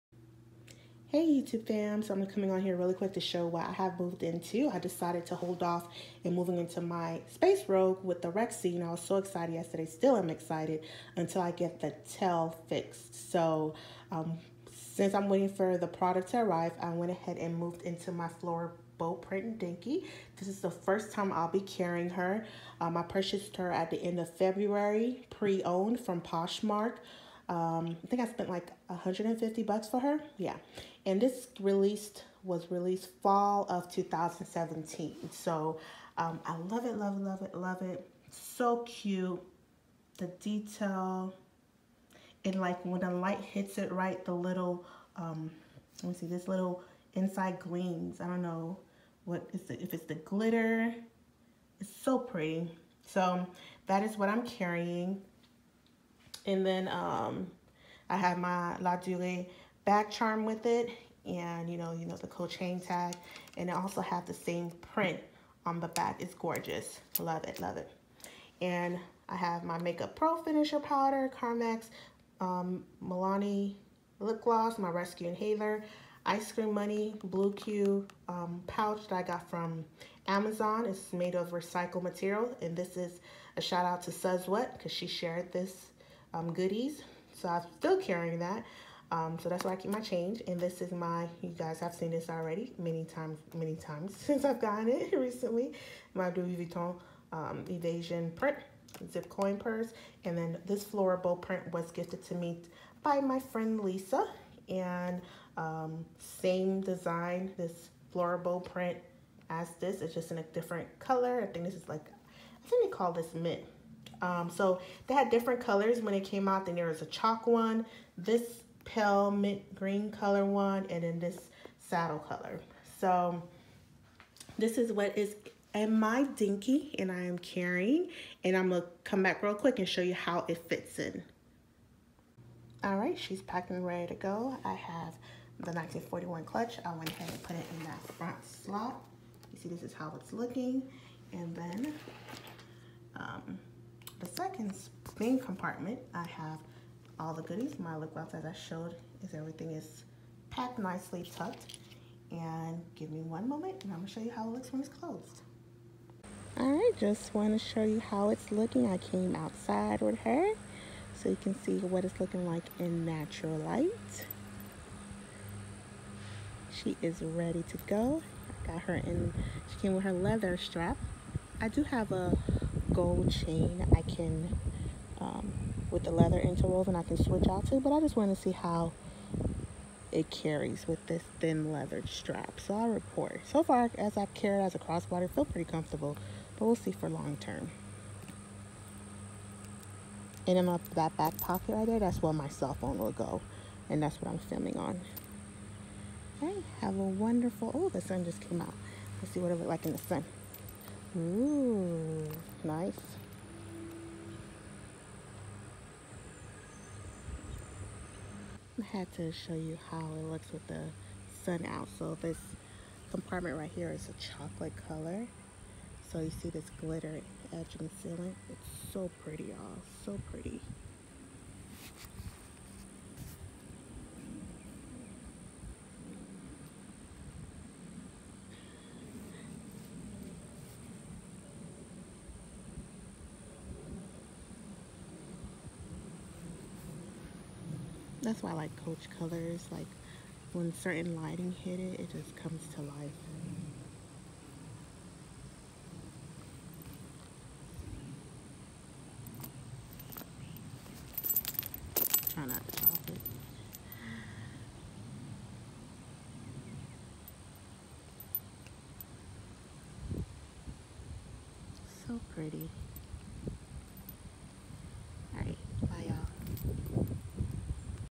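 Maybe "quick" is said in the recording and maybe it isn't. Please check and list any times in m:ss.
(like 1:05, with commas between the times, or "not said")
0:02, 2:09.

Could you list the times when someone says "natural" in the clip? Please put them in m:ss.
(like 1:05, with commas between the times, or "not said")
2:43.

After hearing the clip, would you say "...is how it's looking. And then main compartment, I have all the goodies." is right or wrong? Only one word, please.
right.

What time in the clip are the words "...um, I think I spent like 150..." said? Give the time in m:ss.
0:27.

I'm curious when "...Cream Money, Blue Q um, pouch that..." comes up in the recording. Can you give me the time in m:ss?
1:16.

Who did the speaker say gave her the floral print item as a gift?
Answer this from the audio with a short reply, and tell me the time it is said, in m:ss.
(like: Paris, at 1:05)
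Lisa, at 1:43.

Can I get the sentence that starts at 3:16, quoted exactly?
Okay, have a wonderful, oh, the sun just came out.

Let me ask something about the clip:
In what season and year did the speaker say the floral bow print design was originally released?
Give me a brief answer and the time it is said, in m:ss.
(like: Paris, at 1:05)
fall of 2017, at 0:33.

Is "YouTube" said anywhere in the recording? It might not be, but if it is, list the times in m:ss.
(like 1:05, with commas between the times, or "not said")
0:01.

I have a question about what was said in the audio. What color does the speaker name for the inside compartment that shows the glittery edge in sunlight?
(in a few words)
chocolate.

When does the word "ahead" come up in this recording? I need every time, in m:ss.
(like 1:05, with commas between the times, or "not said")
0:17, 2:17.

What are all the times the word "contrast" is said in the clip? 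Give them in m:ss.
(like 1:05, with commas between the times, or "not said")
not said.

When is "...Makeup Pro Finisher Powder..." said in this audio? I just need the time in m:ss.
1:09.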